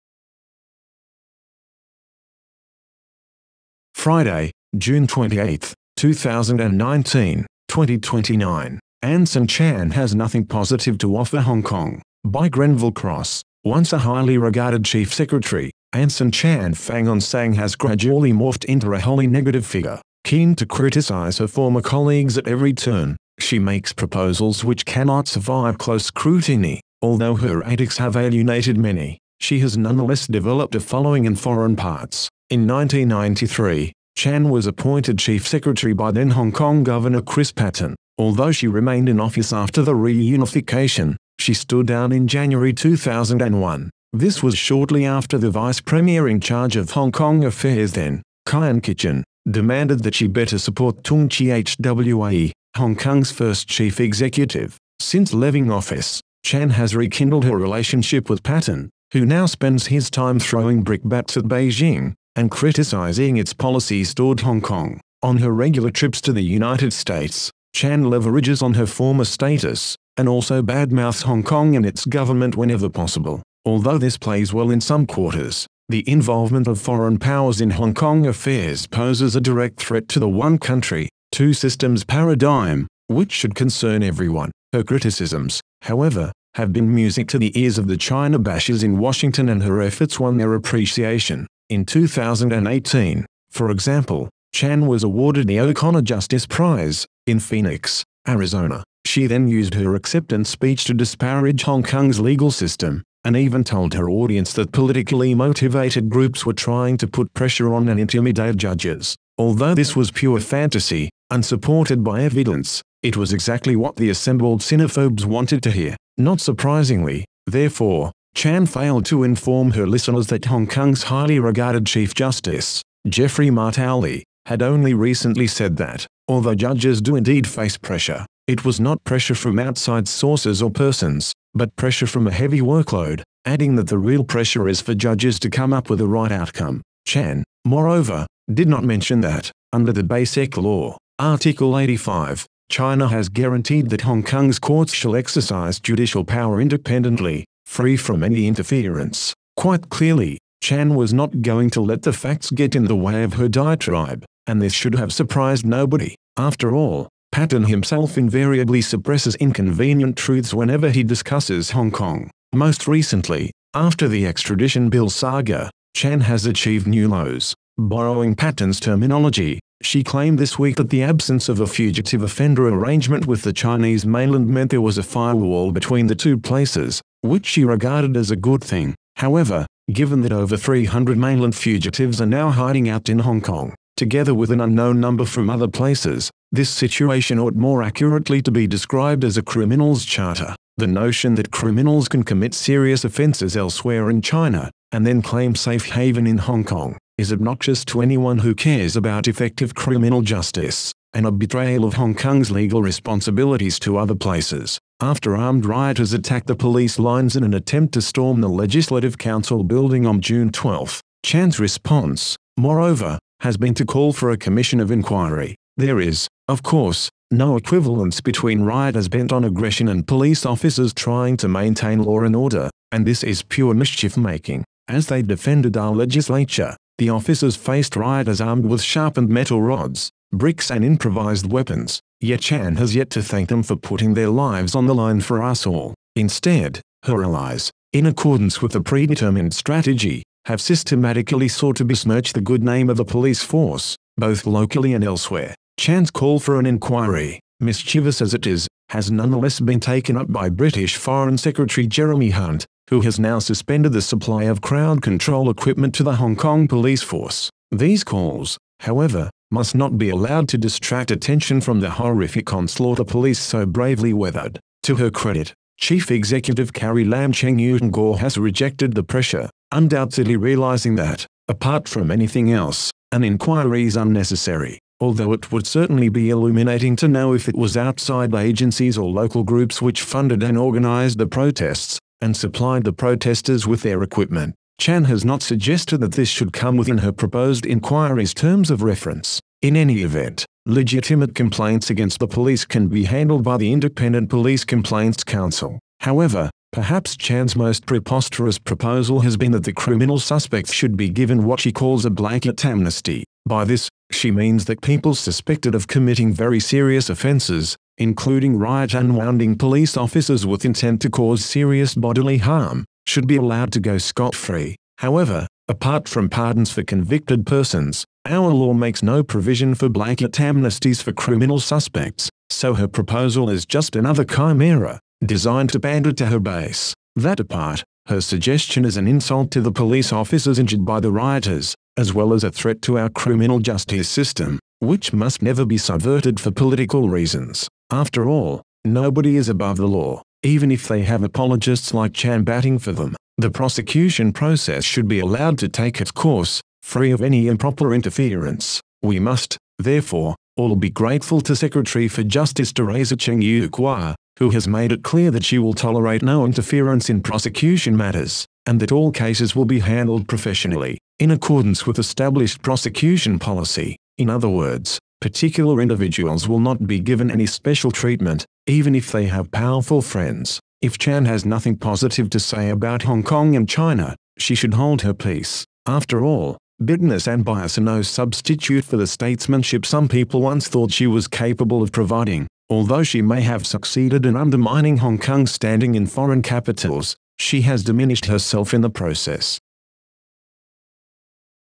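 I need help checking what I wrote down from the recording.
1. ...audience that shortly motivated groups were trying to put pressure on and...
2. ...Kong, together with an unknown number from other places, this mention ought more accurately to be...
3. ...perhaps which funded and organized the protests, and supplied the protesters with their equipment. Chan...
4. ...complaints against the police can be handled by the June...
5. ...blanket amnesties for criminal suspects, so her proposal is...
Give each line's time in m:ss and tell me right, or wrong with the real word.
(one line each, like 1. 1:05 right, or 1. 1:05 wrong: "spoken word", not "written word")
1. 1:44 wrong: "politically", not "shortly"
2. 3:03 wrong: "situation", not "mention"
3. 4:39 wrong: "groups", not "perhaps"
4. 4:51 wrong: "Independent", not "June"
5. 5:19 right.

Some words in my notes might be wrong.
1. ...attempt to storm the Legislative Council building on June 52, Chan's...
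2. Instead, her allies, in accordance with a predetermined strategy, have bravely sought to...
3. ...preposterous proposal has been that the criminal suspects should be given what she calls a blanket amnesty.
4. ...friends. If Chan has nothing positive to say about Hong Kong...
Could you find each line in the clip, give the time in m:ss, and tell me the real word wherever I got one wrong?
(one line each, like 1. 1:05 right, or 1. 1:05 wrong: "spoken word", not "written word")
1. 3:27 wrong: "12", not "52"
2. 3:56 wrong: "systematically", not "bravely"
3. 4:57 right
4. 6:10 right.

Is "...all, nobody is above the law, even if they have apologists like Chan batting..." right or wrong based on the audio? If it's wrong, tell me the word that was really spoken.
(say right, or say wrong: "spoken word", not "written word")
right.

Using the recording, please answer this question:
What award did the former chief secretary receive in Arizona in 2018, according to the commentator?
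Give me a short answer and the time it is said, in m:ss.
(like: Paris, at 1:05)
O'Connor Justice Prize, at 1:35.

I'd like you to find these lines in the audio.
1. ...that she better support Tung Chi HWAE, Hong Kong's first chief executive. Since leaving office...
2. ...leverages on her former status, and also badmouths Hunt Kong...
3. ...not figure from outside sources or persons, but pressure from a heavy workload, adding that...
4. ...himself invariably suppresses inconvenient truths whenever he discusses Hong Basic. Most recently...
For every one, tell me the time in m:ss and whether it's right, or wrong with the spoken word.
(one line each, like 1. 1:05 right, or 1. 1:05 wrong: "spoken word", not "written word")
1. 0:50 right
2. 1:08 wrong: "Hong", not "Hunt"
3. 2:08 wrong: "pressure", not "figure"
4. 2:37 wrong: "Kong", not "Basic".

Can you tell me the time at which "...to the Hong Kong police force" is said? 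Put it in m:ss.
4:15.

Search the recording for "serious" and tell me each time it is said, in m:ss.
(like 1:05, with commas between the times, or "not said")
3:12, 5:06, 5:11.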